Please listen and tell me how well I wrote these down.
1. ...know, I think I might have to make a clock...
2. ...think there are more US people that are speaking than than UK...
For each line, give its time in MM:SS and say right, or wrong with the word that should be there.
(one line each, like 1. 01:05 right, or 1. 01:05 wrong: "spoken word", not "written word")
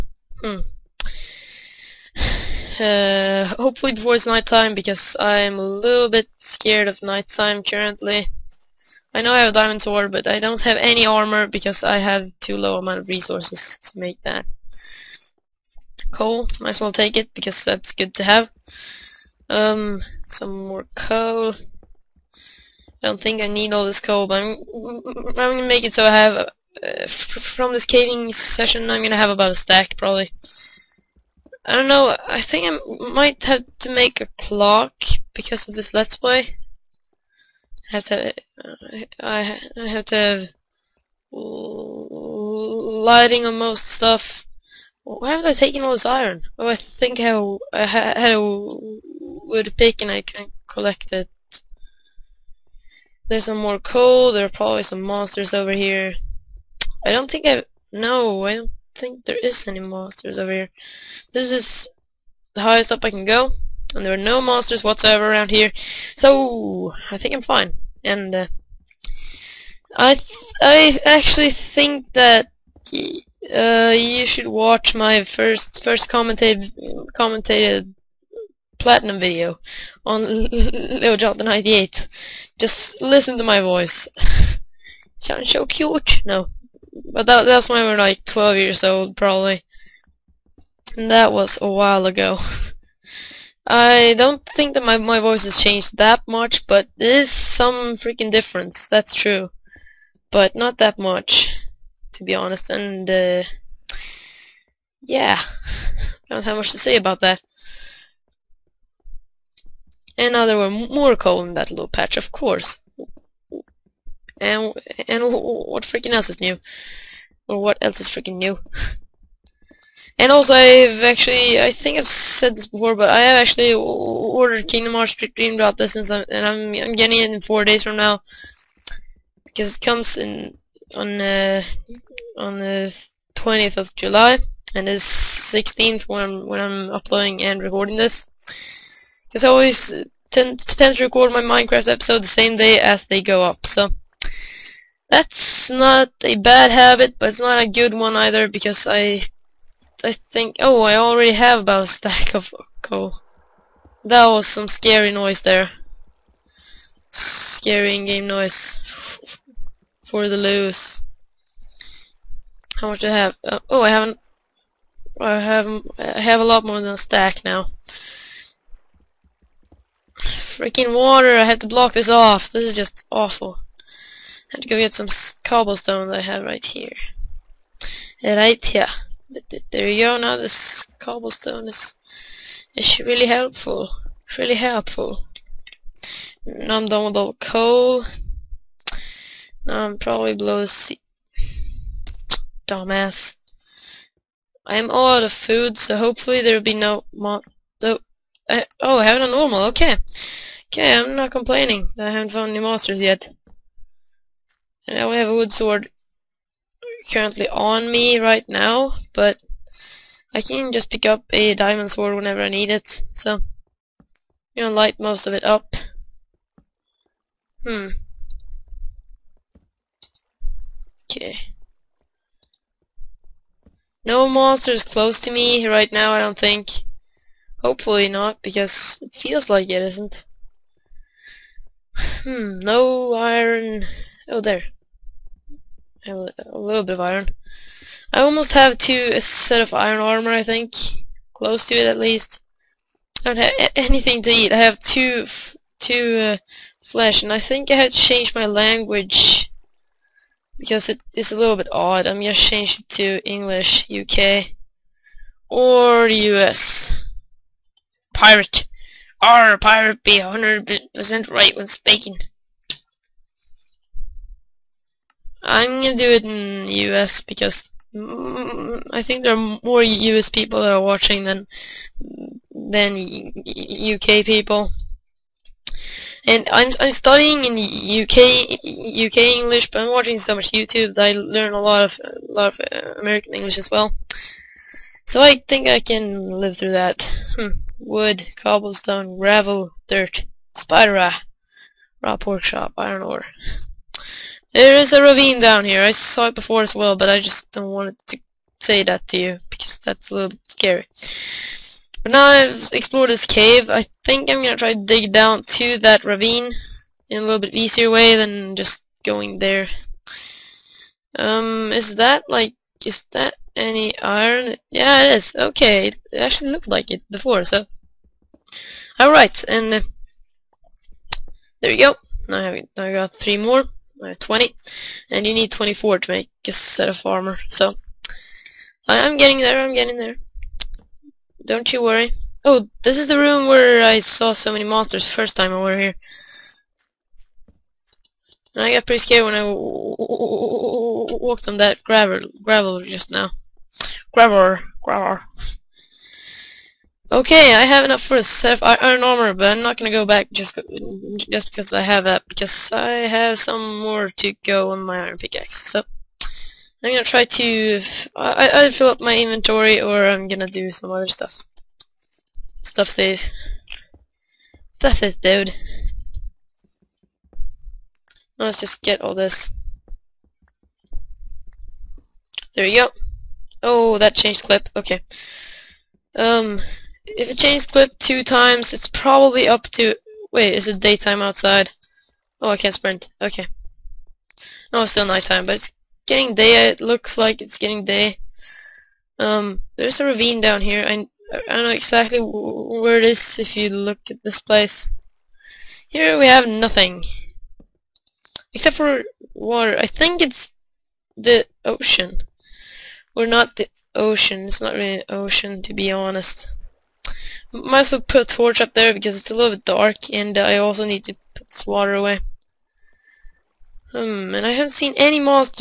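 1. 00:31 right
2. 04:29 wrong: "watching", not "speaking".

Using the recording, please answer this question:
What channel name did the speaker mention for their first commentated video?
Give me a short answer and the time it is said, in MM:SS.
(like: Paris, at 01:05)
Little Jonathan 98, at 01:20.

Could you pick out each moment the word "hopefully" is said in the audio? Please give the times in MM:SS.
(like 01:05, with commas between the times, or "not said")
00:03, 03:15, 03:47.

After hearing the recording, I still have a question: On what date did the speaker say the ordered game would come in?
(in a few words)
20th of July.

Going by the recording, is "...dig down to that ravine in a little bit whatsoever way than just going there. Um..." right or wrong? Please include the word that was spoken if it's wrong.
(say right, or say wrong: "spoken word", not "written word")
wrong: "easier", not "whatsoever".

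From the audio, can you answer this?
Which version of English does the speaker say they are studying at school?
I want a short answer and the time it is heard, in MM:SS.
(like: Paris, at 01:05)
UK English, at 04:37.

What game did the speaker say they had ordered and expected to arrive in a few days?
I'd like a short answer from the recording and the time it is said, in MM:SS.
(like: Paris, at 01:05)
Kingdom Hearts Dream Drop Distance, at 02:04.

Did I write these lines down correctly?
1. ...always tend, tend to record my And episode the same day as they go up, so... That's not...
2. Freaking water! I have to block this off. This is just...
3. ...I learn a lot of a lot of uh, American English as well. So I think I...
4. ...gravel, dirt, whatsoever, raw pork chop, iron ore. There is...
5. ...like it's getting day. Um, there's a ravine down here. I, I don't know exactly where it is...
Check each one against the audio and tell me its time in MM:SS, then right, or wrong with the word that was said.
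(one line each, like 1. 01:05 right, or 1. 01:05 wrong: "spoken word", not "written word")
1. 02:19 wrong: "Minecraft", not "And"
2. 02:50 right
3. 04:41 right
4. 04:49 wrong: "spider", not "whatsoever"
5. 06:27 right.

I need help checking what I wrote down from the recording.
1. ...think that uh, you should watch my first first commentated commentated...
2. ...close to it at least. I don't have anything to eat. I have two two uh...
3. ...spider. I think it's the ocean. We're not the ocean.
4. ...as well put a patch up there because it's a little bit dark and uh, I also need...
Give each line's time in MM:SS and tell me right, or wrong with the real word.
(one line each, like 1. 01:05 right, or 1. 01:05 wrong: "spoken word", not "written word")
1. 01:11 right
2. 04:01 right
3. 06:39 wrong: "water", not "spider"
4. 06:47 wrong: "torch", not "patch".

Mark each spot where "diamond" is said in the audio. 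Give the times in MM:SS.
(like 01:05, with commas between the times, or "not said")
00:09, 03:31.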